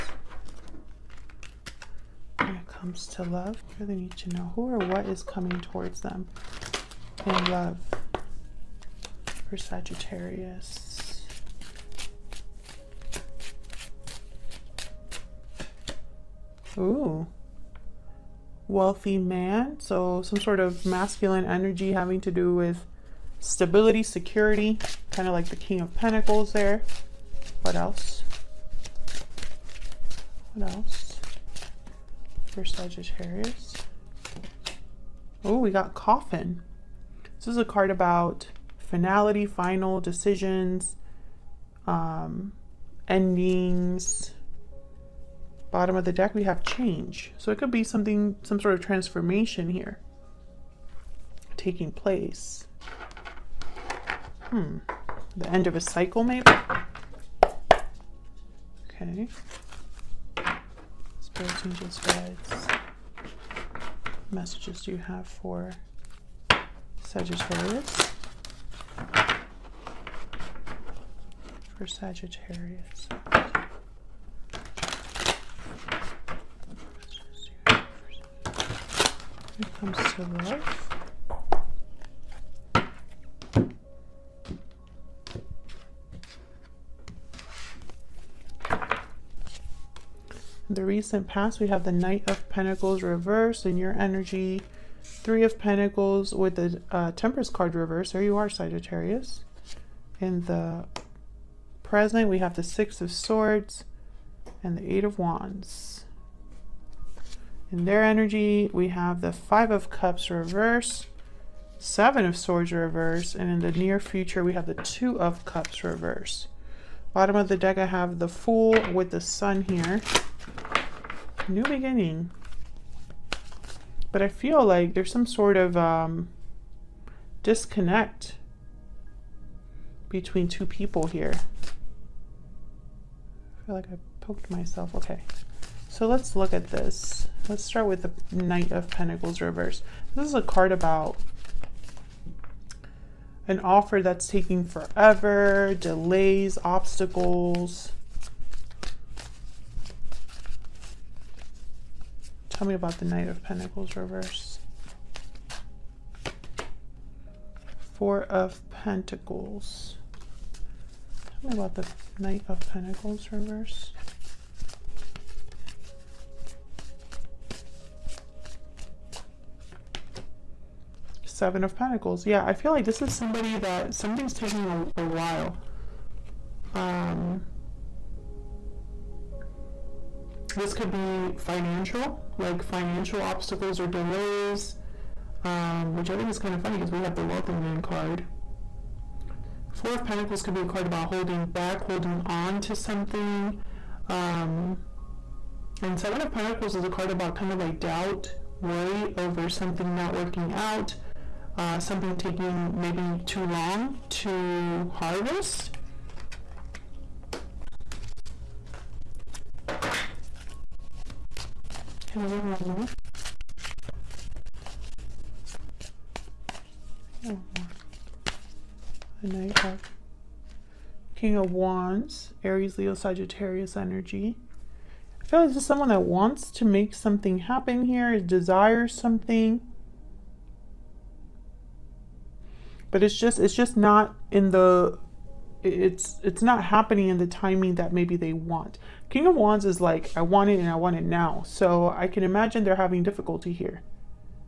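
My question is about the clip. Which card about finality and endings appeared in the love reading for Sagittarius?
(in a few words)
Coffin.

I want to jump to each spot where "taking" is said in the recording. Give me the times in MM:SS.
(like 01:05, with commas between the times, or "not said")
00:51, 02:24, 02:54, 03:22.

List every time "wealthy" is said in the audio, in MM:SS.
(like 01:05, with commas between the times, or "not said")
00:18, 03:07.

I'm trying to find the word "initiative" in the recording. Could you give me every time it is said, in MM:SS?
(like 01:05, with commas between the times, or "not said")
not said.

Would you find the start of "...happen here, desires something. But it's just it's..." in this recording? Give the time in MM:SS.
03:47.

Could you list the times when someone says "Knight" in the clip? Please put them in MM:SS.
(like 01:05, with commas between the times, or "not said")
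01:31, 02:18, 02:33, 02:42, 03:39.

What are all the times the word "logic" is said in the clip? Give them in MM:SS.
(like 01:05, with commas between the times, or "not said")
not said.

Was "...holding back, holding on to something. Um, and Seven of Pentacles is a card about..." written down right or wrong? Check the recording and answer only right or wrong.
right.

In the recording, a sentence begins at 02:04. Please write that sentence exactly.
But I feel like there's some sort of um, disconnect between two people here.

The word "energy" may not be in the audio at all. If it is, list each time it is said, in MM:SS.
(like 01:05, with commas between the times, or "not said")
00:21, 01:33, 01:48, 03:43.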